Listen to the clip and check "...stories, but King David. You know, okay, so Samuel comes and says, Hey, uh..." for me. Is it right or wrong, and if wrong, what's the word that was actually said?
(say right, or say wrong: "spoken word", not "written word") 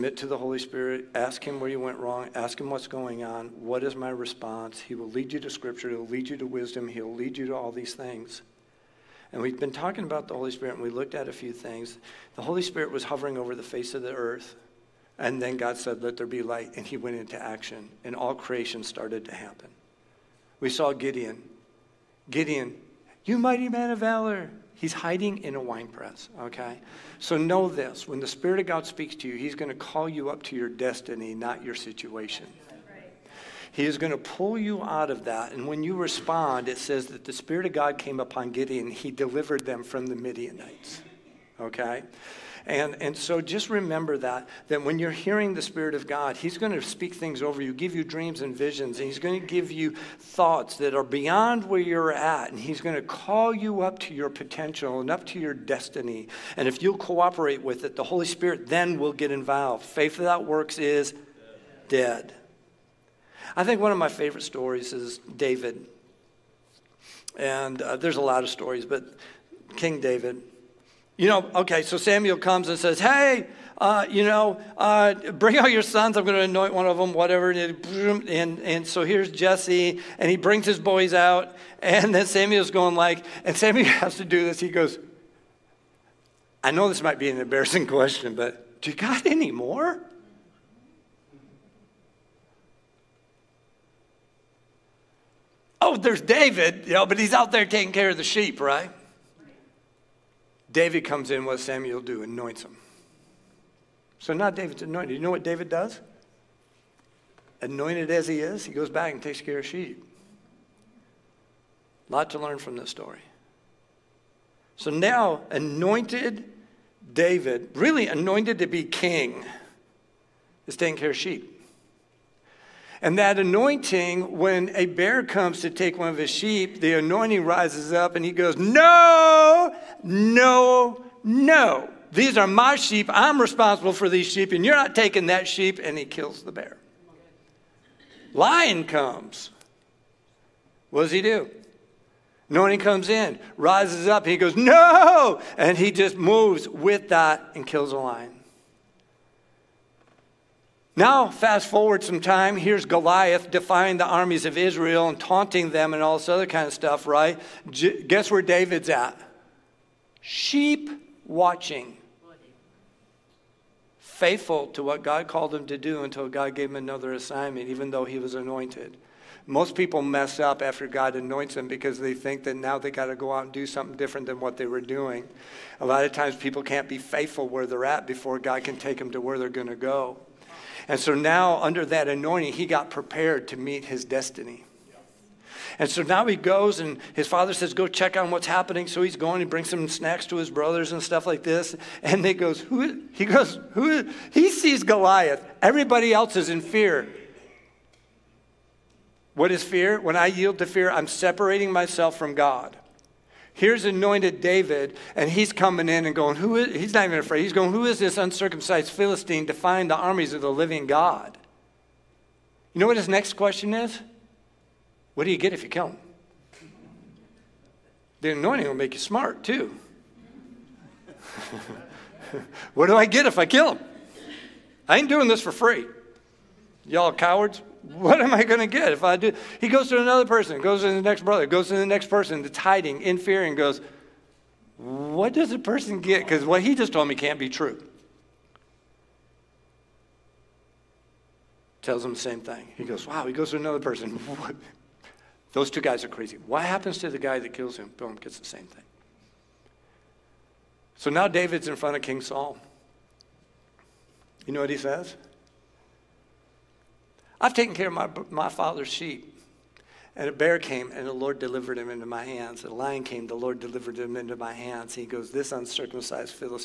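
right.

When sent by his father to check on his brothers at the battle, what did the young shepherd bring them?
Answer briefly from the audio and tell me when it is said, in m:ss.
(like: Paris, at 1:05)
Snacks, at 3:09.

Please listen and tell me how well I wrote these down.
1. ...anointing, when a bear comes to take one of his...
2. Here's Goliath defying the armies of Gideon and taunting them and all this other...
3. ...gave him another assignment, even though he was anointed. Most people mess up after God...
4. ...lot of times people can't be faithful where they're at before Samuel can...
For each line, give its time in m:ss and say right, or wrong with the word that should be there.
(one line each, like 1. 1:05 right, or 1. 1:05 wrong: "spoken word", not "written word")
1. 2:03 right
2. 2:32 wrong: "Israel", not "Gideon"
3. 2:46 right
4. 2:55 wrong: "God", not "Samuel".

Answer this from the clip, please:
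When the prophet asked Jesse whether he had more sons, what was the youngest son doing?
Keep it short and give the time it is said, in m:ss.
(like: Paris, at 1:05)
Taking care of the sheep, at 1:37.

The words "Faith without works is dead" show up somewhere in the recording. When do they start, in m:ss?
0:59.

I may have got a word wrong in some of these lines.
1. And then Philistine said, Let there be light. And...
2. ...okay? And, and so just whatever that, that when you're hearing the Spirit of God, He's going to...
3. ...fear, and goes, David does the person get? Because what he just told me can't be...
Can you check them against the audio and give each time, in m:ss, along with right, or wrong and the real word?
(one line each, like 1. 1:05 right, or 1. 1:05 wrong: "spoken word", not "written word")
1. 0:15 wrong: "God", not "Philistine"
2. 0:41 wrong: "remember", not "whatever"
3. 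3:53 wrong: "What", not "David".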